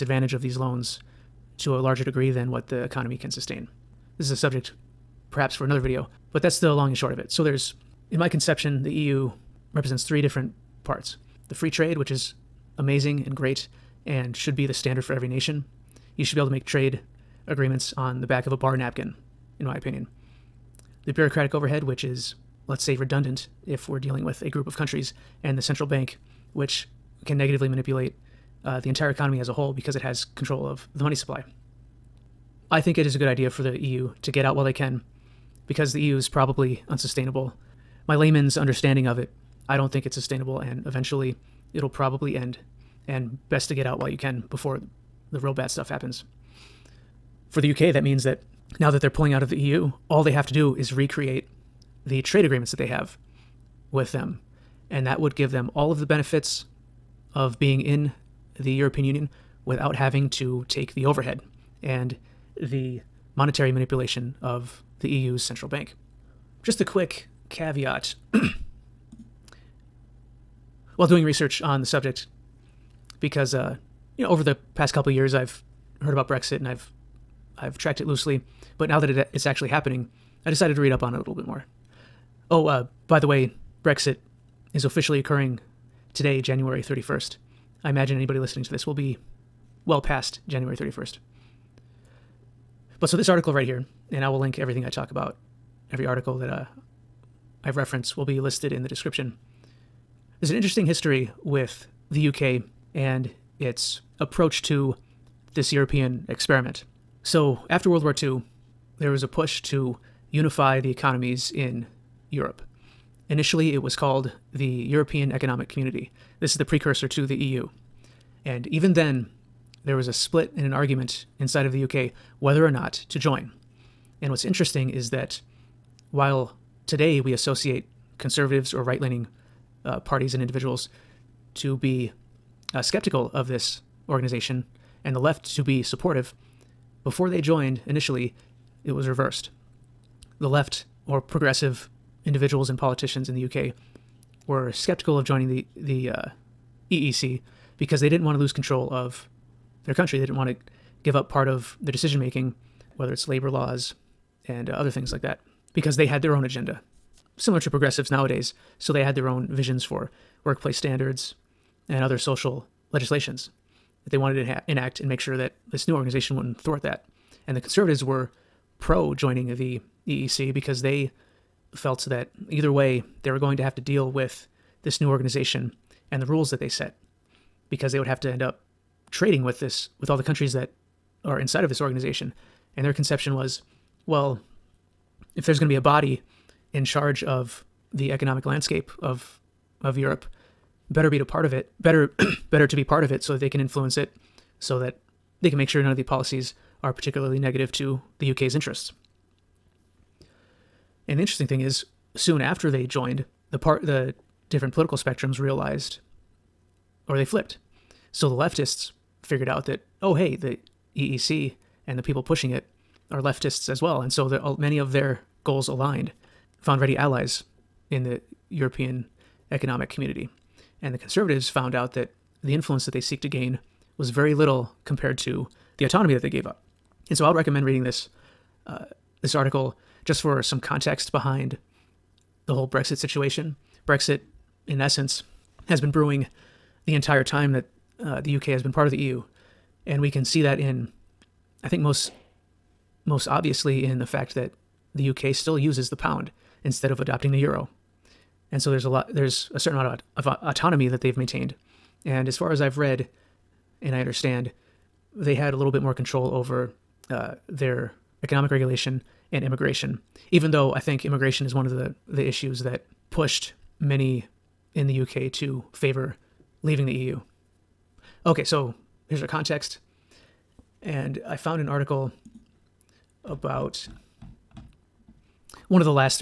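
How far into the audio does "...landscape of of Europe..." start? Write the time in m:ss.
3:08.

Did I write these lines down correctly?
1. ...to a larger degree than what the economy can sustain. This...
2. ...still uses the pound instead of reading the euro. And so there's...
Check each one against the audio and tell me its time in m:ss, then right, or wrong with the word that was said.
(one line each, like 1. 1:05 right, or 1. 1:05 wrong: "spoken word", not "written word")
1. 0:01 right
2. 4:05 wrong: "adopting", not "reading".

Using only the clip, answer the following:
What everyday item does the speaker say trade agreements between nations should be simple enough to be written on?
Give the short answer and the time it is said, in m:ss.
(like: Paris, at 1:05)
Back of a bar napkin, at 0:18.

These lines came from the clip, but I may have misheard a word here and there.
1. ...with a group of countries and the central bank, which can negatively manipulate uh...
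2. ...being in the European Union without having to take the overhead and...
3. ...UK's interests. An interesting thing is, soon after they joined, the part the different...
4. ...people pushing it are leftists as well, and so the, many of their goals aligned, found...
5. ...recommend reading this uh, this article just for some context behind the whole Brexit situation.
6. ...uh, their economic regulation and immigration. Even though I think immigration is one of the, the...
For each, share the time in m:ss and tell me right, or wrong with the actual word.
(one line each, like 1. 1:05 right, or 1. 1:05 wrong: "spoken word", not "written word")
1. 0:24 right
2. 0:57 right
3. 3:18 right
4. 3:32 right
5. 3:47 right
6. 4:17 right.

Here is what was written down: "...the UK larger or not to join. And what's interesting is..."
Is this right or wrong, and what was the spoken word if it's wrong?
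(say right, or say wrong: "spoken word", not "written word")
wrong: "whether", not "larger".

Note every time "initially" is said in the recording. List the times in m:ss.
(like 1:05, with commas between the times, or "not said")
1:53, 2:17.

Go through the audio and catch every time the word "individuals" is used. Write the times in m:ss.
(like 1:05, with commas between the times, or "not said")
2:10, 2:22.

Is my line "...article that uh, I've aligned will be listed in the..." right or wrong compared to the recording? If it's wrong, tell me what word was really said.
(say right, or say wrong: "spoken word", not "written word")
wrong: "referenced", not "aligned".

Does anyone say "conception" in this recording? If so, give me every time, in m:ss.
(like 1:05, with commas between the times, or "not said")
0:08, 3:02.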